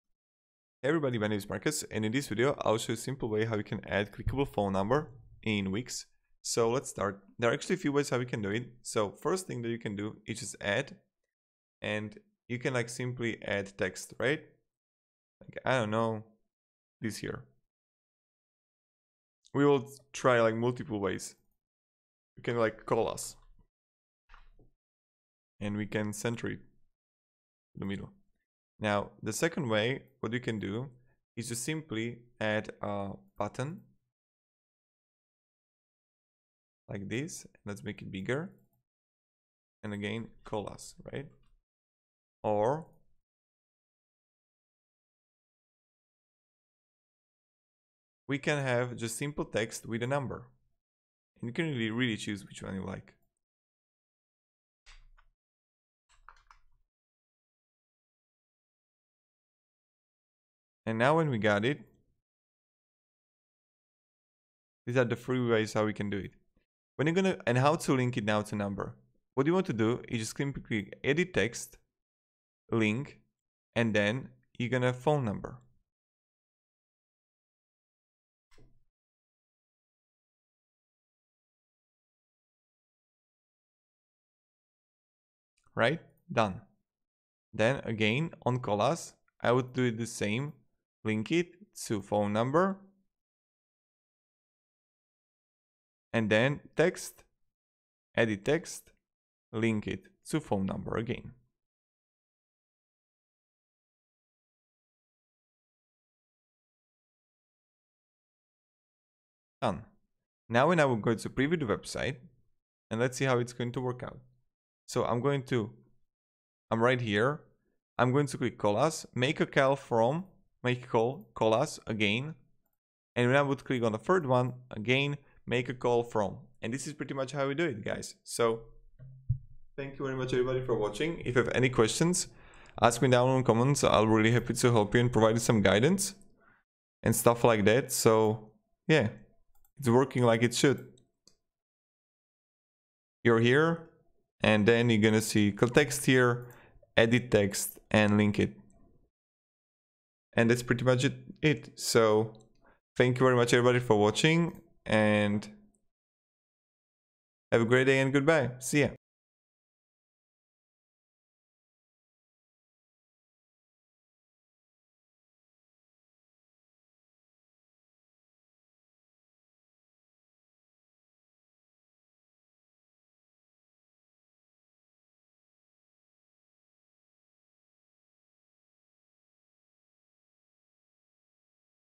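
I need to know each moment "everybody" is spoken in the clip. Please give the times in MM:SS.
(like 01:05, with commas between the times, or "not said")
00:00, 02:10, 02:33.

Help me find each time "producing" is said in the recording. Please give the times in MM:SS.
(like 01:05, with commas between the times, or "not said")
not said.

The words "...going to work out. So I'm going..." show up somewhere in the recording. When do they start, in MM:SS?
01:53.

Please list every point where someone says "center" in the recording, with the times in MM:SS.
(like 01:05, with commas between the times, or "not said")
00:26.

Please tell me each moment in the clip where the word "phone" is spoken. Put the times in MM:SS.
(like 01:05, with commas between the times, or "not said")
00:04, 01:14, 01:32, 01:40.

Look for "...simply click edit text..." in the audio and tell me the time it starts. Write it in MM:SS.
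01:10.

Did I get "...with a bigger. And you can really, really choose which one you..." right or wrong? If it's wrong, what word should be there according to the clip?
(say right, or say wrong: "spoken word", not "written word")
wrong: "number", not "bigger".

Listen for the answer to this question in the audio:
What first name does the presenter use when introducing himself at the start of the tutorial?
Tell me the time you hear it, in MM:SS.
00:01.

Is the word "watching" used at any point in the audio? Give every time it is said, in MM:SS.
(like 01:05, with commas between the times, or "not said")
02:10, 02:33.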